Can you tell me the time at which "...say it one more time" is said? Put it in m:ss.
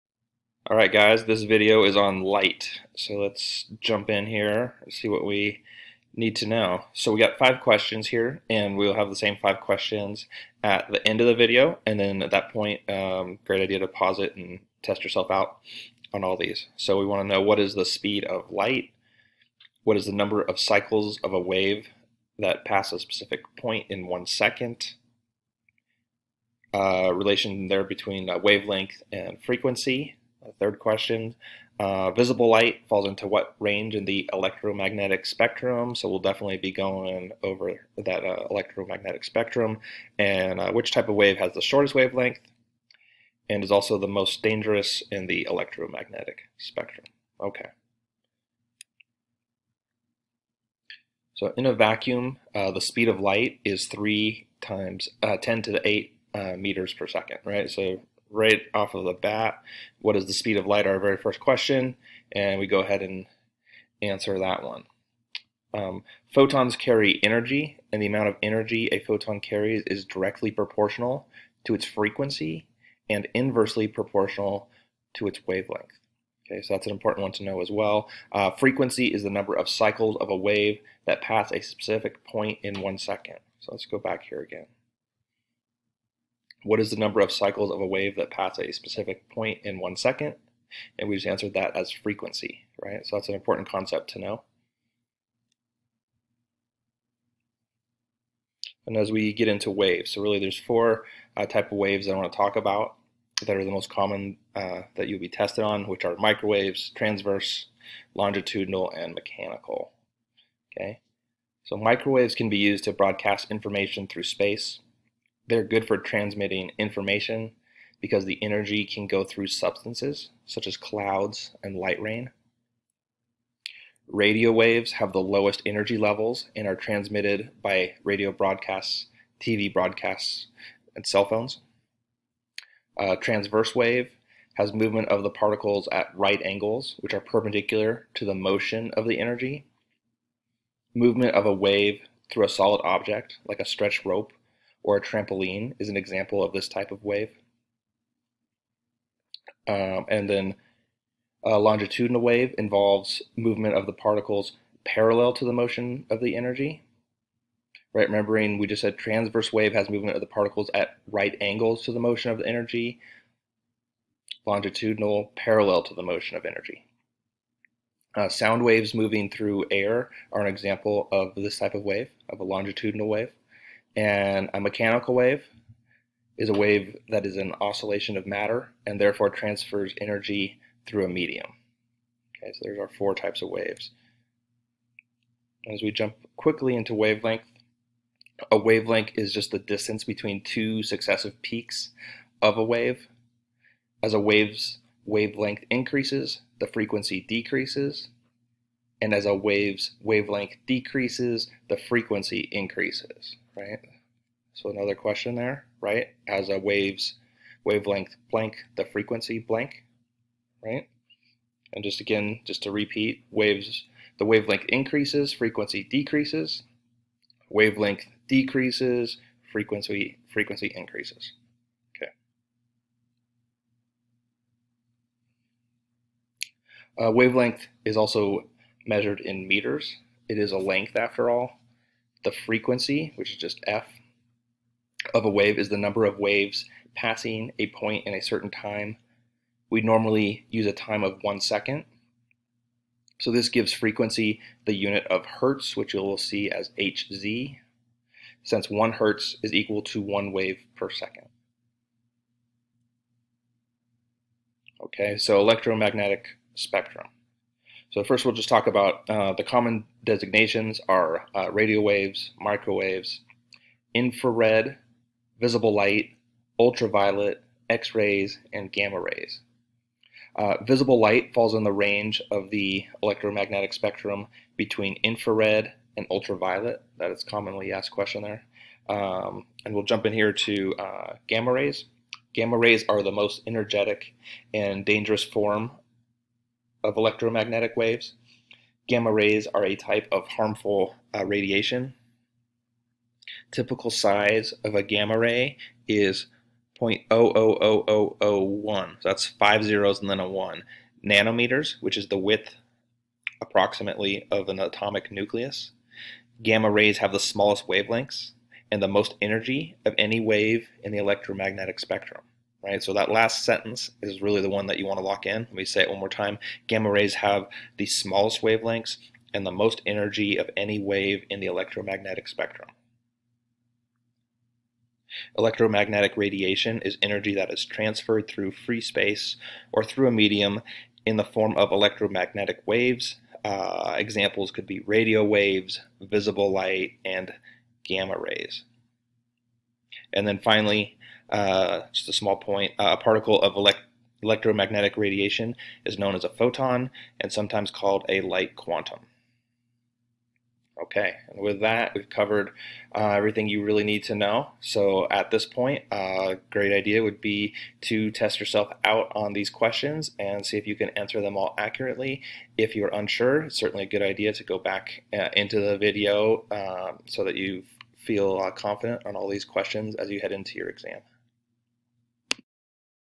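5:15.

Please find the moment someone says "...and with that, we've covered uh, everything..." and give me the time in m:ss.
5:51.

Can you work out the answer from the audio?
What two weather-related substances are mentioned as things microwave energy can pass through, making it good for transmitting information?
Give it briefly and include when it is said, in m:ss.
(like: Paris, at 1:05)
Clouds and light rain, at 2:00.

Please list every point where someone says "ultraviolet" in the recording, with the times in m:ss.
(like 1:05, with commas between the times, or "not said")
4:26, 4:36.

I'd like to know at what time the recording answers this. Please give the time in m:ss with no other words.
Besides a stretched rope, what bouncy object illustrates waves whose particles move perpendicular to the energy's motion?
2:24.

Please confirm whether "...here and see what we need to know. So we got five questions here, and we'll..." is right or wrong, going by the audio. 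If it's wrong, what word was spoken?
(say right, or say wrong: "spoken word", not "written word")
right.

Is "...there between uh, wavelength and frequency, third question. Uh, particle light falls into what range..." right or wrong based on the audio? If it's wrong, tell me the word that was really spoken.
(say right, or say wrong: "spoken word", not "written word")
wrong: "visible", not "particle".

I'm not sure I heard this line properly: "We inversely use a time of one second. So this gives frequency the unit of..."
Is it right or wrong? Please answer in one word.
wrong.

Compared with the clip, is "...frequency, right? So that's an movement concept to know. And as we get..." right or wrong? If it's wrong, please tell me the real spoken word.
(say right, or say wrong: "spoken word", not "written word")
wrong: "important", not "movement".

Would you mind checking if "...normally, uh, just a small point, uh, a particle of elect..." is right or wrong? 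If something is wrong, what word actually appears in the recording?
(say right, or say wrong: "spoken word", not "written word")
wrong: "finally", not "normally".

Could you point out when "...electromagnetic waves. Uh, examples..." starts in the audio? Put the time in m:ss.
5:31.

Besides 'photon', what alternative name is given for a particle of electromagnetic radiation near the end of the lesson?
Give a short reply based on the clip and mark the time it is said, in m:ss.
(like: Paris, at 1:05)
Light quantum, at 5:48.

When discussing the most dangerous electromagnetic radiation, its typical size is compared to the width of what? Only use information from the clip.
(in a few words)
An atomic nucleus.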